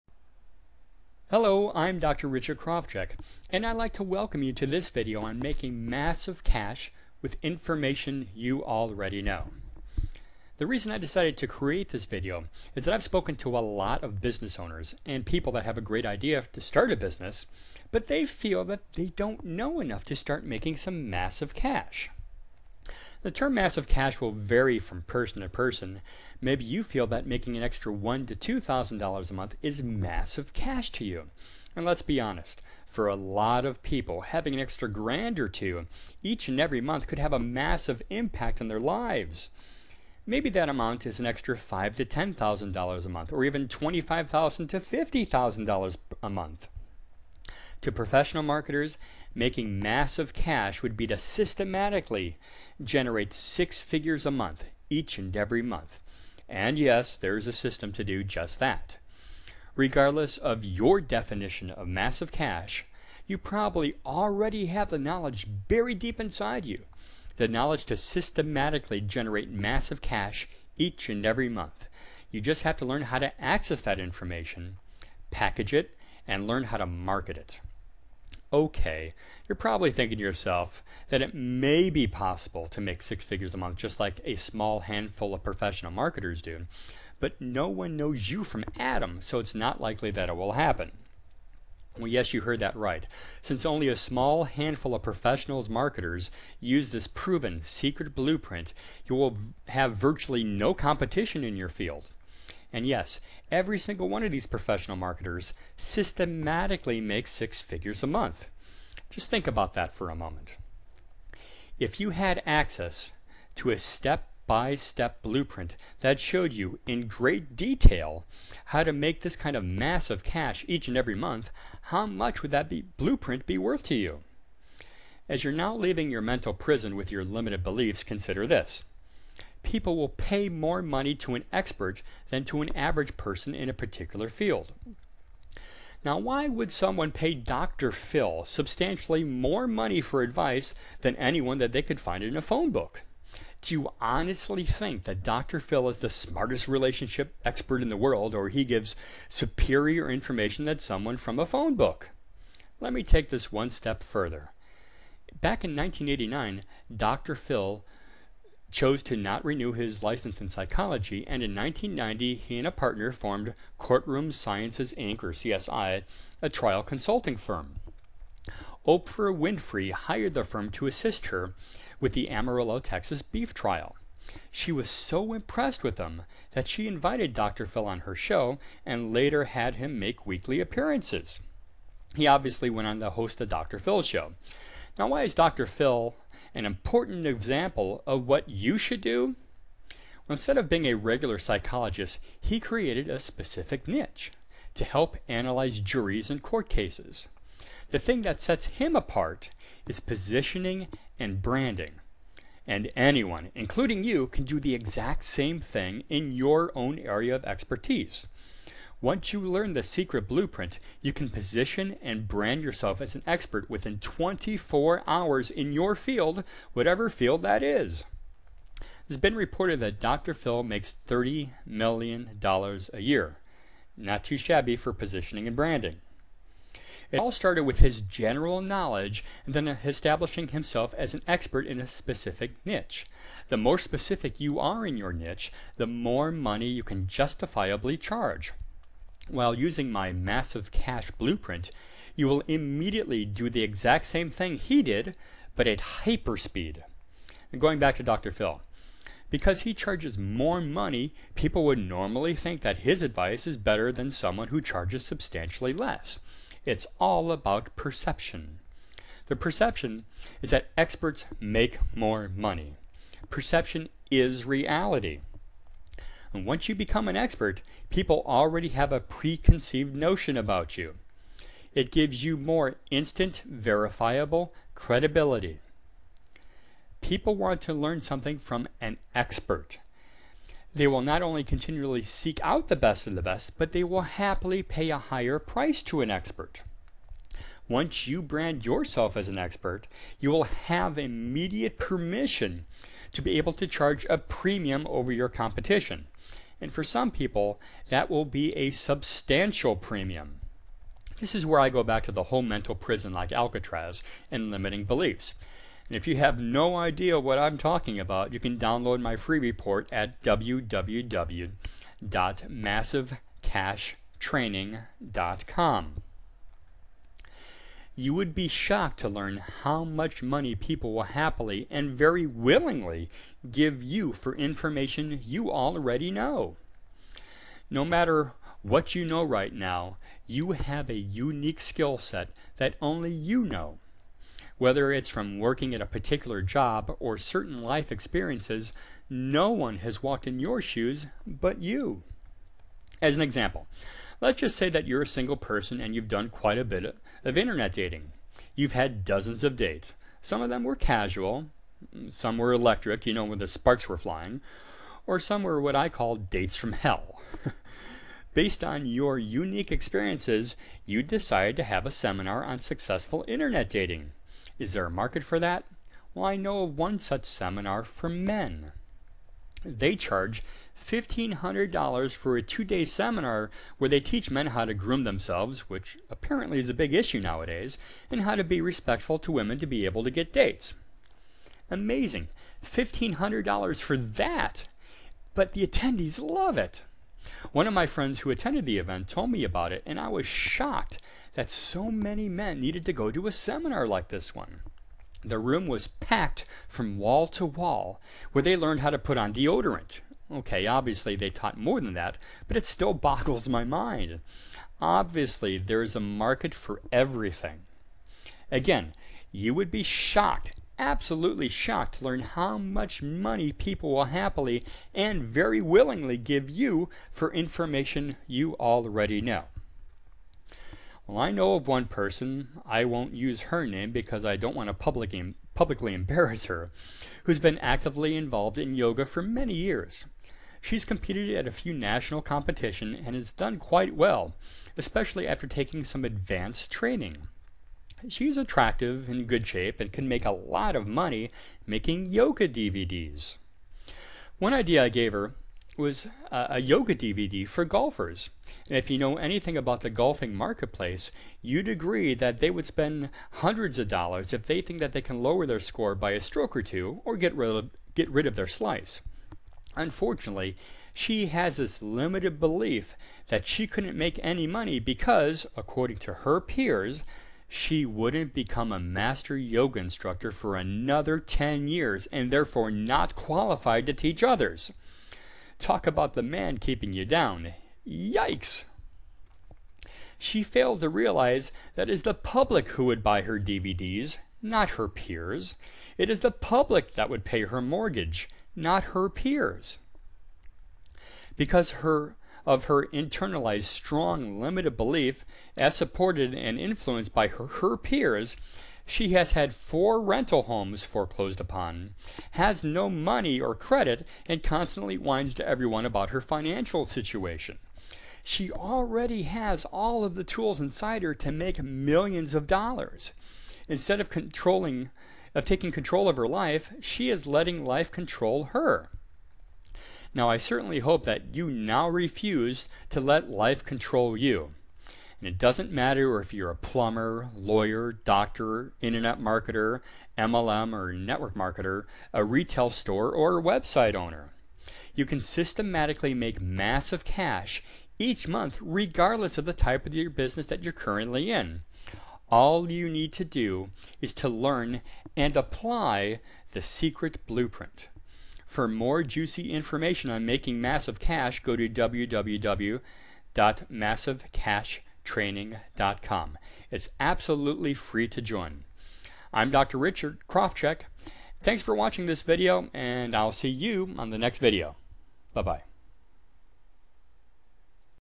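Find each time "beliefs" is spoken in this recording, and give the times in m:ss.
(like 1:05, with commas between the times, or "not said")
2:07, 5:04, 7:42, 8:14.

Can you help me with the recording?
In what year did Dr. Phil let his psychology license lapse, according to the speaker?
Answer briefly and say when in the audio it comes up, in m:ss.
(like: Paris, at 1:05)
1989, at 2:35.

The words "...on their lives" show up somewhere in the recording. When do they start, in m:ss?
0:38.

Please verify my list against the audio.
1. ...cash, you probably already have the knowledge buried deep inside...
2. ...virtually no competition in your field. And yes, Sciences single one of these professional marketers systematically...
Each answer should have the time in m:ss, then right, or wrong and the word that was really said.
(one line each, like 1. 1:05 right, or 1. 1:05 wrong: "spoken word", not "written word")
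1. 1:02 right
2. 1:39 wrong: "Every", not "Sciences".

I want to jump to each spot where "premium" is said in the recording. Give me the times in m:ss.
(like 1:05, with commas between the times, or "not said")
4:54, 4:59.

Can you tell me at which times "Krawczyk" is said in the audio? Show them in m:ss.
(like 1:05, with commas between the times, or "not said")
0:02, 9:20.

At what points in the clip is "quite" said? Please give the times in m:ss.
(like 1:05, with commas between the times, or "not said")
5:46, 7:13.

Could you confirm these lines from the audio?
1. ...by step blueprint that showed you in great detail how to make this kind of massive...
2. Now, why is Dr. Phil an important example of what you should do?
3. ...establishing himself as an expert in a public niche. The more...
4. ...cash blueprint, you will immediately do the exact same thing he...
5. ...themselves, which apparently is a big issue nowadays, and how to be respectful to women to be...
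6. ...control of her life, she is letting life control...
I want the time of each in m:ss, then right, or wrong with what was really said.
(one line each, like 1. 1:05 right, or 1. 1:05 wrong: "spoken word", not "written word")
1. 1:54 right
2. 3:04 right
3. 3:49 wrong: "specific", not "public"
4. 4:00 right
5. 6:15 right
6. 8:35 right.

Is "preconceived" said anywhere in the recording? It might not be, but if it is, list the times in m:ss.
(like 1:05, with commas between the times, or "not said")
4:29.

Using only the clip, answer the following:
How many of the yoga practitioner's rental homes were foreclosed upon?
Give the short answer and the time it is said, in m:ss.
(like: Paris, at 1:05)
4, at 8:19.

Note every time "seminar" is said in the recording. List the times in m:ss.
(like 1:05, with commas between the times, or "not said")
6:01, 6:07, 6:12, 6:33.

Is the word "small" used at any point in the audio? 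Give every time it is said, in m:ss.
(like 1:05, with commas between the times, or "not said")
1:24, 1:33.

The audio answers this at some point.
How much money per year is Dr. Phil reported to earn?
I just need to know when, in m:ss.
3:41.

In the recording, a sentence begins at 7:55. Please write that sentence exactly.
Talk about the man keeping you down.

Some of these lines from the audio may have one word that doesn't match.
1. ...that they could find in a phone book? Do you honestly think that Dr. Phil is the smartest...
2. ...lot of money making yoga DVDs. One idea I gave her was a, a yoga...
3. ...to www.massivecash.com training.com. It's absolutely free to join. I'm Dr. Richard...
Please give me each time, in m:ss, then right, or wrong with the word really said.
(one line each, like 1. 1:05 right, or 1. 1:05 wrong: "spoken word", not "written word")
1. 2:21 right
2. 7:20 right
3. 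9:11 right.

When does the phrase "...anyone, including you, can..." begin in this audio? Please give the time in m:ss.
3:22.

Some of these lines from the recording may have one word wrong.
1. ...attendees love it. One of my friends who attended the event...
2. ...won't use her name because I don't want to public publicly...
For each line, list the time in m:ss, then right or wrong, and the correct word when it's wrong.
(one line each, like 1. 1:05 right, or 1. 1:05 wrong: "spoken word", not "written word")
1. 6:25 right
2. 7:02 right.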